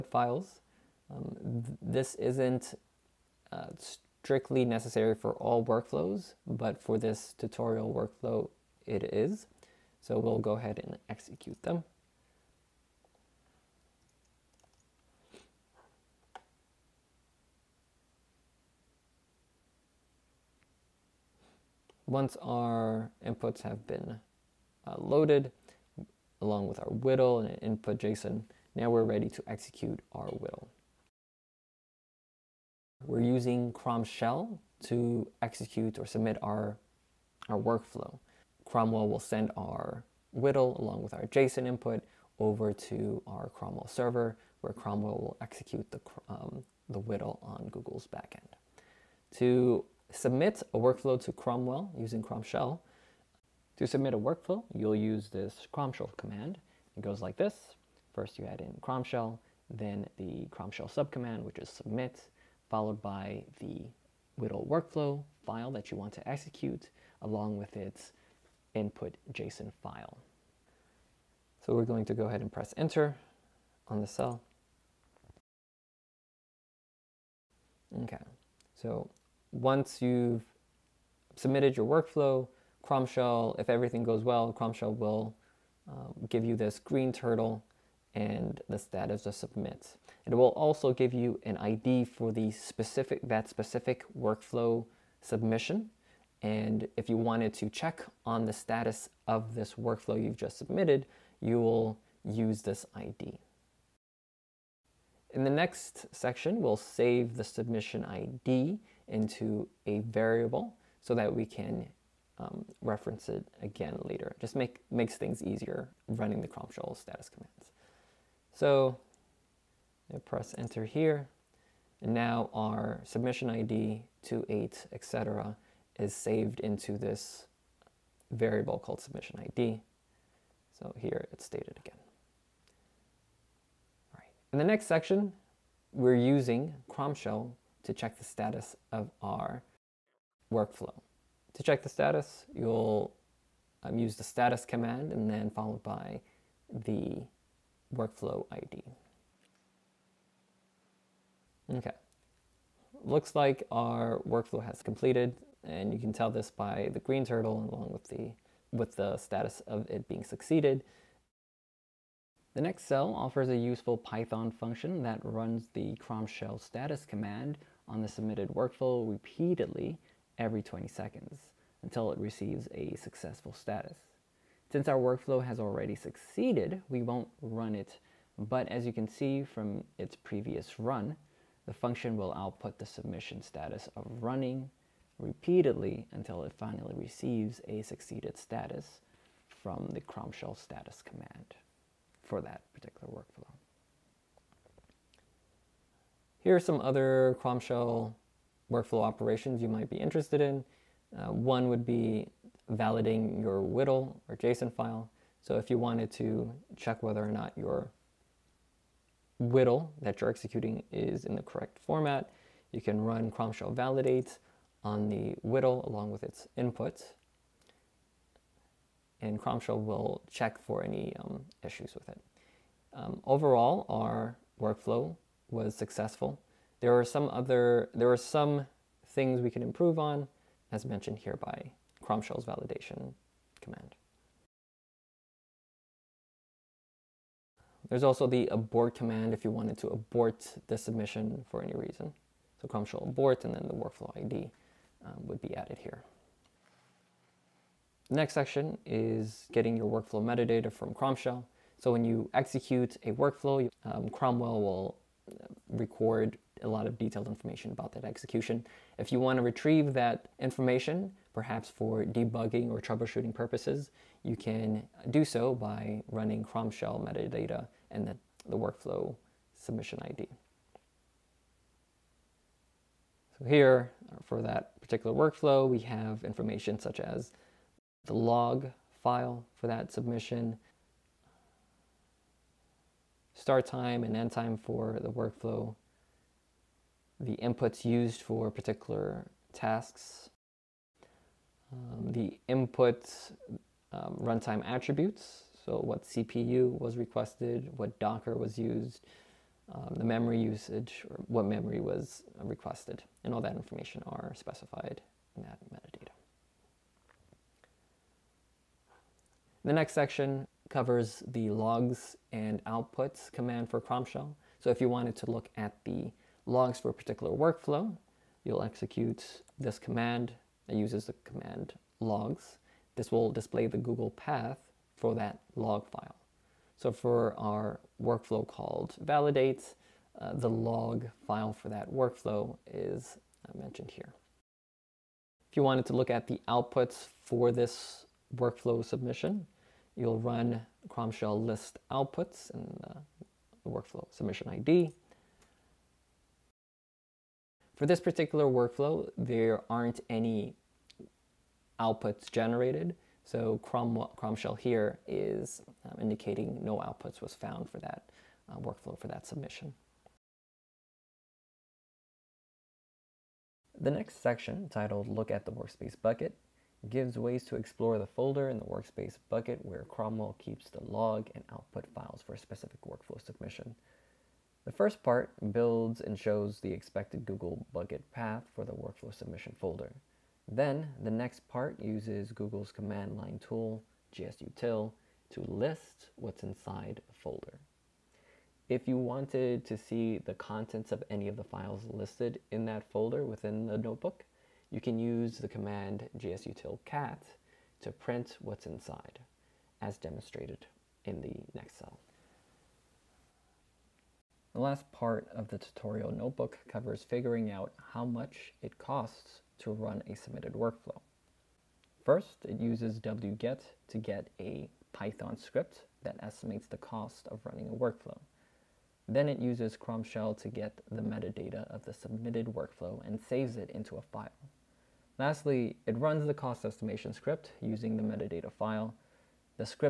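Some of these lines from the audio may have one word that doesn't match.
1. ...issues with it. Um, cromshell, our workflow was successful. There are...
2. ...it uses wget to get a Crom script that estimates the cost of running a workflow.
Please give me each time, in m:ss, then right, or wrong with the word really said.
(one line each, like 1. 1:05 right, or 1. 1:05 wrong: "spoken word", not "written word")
1. 3:41 wrong: "overall", not "cromshell"
2. 6:52 wrong: "Python", not "Crom".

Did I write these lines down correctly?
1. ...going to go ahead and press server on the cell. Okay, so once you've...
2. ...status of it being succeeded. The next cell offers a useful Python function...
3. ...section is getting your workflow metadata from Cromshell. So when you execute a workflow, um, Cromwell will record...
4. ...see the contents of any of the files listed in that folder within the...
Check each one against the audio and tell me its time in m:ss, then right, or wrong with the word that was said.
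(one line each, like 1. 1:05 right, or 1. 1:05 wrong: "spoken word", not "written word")
1. 1:11 wrong: "enter", not "server"
2. 2:39 right
3. 4:08 right
4. 6:29 right.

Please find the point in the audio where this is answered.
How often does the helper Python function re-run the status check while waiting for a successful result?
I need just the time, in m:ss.
2:50.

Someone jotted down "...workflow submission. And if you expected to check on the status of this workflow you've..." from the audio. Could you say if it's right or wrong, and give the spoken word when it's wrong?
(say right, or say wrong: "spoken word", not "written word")
wrong: "wanted", not "expected".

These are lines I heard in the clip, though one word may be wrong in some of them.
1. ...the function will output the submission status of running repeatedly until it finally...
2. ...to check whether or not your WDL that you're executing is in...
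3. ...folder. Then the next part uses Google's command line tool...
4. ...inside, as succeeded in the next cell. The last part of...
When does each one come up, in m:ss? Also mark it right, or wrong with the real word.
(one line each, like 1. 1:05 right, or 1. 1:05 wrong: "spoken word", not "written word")
1. 3:01 right
2. 3:26 right
3. 6:19 right
4. 6:38 wrong: "demonstrated", not "succeeded".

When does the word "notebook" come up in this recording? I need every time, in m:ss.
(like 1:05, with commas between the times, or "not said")
6:33, 6:46.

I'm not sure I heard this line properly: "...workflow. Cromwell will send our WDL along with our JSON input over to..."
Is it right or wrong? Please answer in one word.
right.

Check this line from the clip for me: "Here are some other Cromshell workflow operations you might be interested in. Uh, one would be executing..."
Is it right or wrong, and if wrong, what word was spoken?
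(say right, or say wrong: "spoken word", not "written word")
wrong: "validating", not "executing".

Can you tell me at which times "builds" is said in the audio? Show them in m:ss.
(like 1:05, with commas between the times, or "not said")
6:15.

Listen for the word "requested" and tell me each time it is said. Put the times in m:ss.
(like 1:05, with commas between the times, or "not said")
4:56, 5:02.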